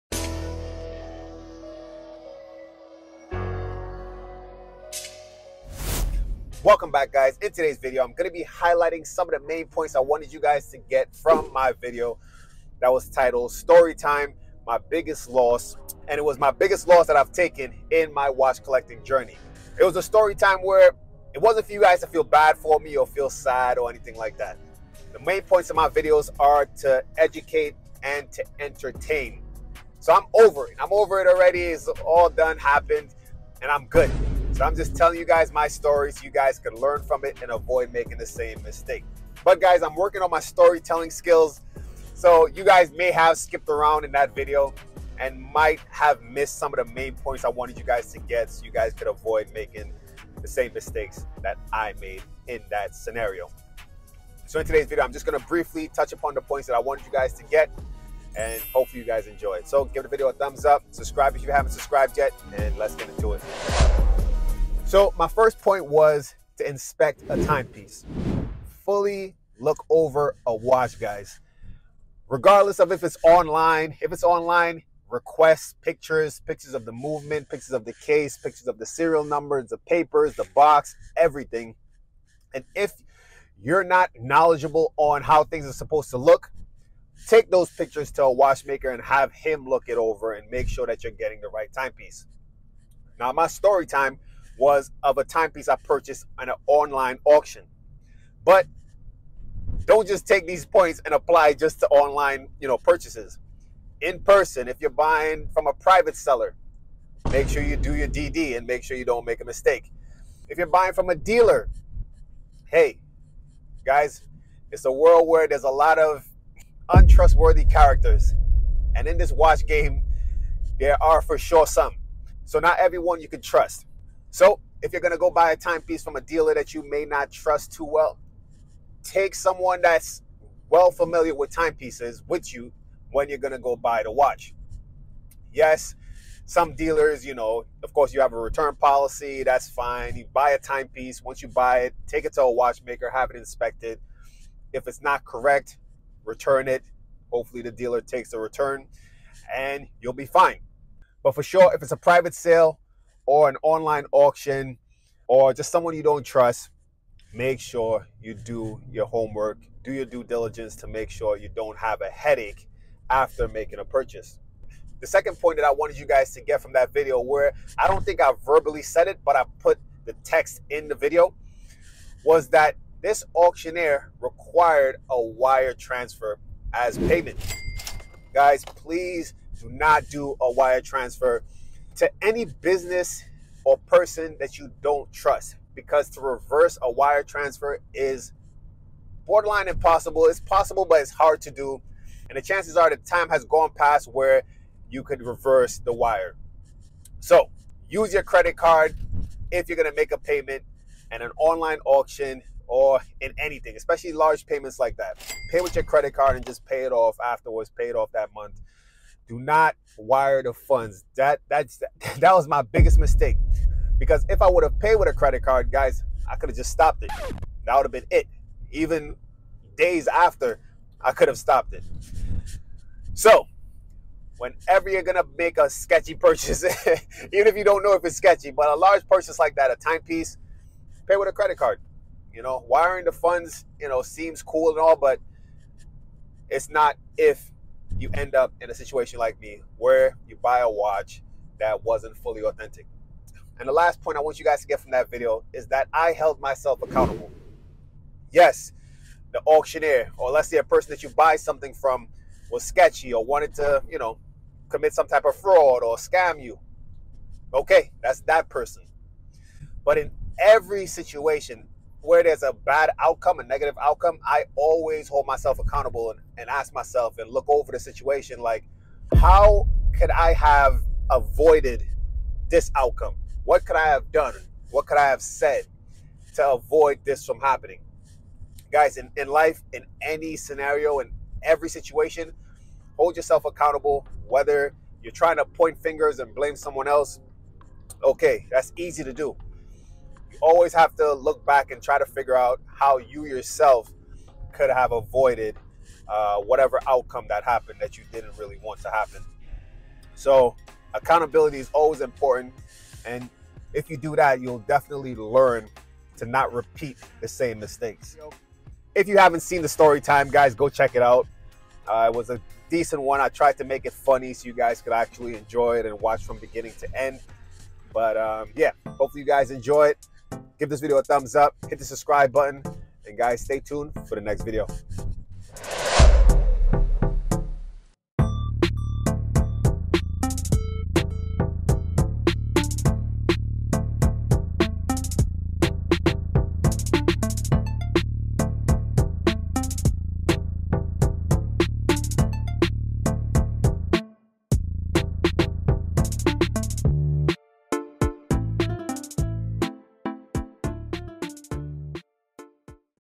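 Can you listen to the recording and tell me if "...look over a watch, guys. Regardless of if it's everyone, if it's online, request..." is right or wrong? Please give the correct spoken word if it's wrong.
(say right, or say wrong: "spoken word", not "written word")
wrong: "online", not "everyone".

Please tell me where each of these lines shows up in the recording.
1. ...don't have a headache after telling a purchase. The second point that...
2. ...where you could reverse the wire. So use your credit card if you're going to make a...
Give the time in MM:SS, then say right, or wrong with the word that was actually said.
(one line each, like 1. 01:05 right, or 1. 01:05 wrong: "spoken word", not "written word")
1. 02:41 wrong: "making", not "telling"
2. 03:14 right.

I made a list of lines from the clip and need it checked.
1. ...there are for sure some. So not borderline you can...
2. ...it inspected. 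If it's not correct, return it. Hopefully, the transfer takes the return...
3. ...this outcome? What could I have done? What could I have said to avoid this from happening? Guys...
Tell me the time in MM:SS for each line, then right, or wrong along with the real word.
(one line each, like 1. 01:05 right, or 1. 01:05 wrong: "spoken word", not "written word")
1. 02:00 wrong: "everyone", not "borderline"
2. 02:23 wrong: "dealer", not "transfer"
3. 04:32 right.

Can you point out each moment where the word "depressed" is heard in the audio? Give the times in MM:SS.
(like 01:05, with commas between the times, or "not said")
not said.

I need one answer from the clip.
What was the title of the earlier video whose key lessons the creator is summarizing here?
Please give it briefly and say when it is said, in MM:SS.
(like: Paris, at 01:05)
Story Time, My Biggest Loss, at 00:13.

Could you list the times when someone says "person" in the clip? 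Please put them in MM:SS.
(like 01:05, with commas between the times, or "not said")
01:44, 03:03, 04:10, 04:18.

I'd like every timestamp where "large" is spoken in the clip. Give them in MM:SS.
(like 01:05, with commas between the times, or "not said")
03:24, 03:48.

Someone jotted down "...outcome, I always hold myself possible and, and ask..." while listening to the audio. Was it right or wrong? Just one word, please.
wrong.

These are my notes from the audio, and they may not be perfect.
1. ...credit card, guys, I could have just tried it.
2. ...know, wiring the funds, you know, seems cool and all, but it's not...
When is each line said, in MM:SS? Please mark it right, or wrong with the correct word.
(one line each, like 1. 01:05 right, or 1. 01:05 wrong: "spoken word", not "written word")
1. 03:35 wrong: "stopped", not "tried"
2. 03:52 right.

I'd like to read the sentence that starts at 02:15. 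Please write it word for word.
Yes, some dealers, you know, of course, you have a return policy.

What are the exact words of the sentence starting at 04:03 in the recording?
And the last point I want you guys to get from that video is that I held myself accountable.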